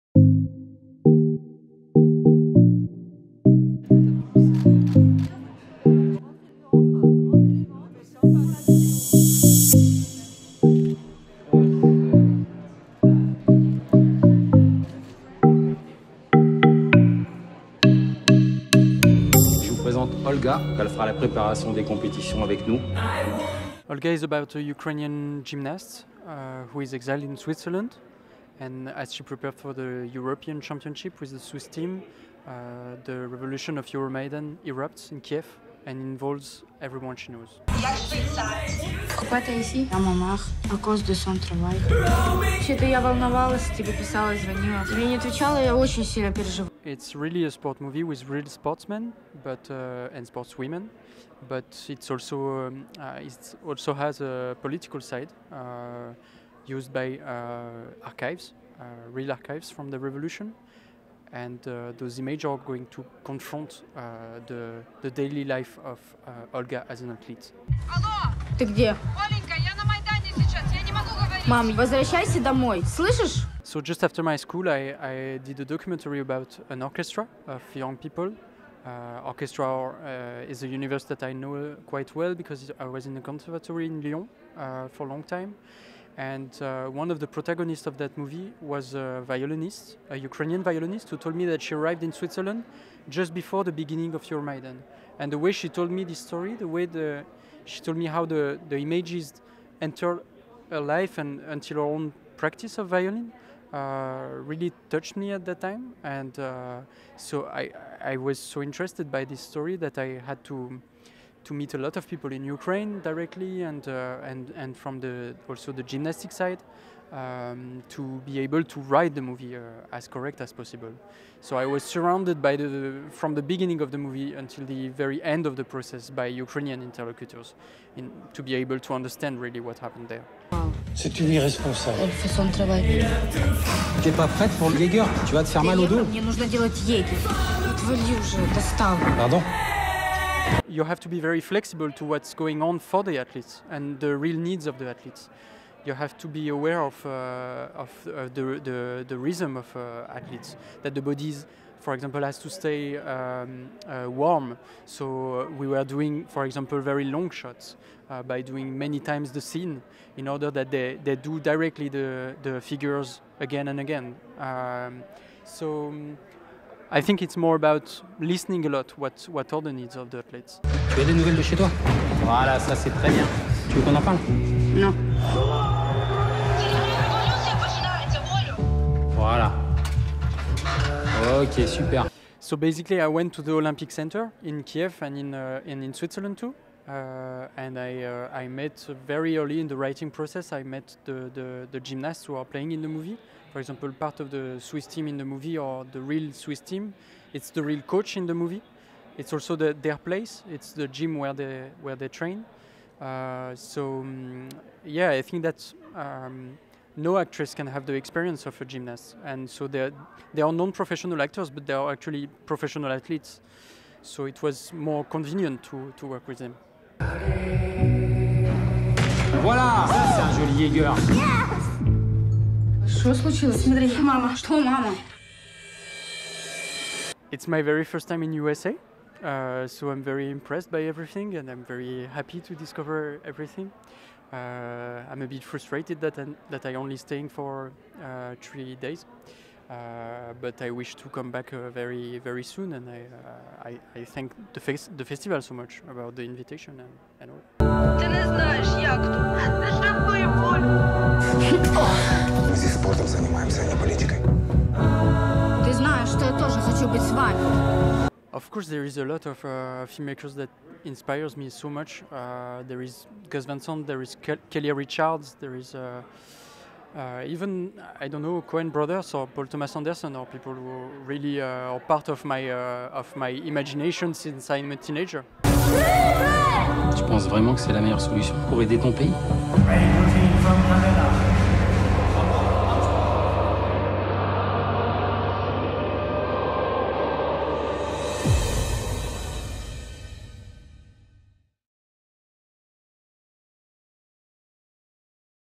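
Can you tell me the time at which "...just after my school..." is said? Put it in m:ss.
1:13.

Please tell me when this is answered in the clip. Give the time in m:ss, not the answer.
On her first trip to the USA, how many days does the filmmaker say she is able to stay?
3:58.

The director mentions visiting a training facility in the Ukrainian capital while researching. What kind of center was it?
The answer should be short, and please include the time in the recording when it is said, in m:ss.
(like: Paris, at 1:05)
Olympic Center, at 3:03.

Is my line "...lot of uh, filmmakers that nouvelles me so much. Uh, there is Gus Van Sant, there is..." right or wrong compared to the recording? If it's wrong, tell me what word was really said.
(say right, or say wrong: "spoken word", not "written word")
wrong: "inspires", not "nouvelles".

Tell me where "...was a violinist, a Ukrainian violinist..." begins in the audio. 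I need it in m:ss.
1:28.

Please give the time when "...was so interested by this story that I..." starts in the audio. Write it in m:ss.
1:48.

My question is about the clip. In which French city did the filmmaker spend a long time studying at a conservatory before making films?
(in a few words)
Lyon.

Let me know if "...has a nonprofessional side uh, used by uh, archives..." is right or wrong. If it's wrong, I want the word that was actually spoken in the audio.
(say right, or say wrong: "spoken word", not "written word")
wrong: "political", not "nonprofessional".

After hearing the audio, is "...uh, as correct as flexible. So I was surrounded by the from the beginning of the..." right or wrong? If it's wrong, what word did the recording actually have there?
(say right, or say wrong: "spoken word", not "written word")
wrong: "possible", not "flexible".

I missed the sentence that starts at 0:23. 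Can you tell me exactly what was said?
Olga is about a Ukrainian gymnast uh, who is exiled in Switzerland.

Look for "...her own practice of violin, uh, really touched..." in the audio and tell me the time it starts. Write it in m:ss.
1:41.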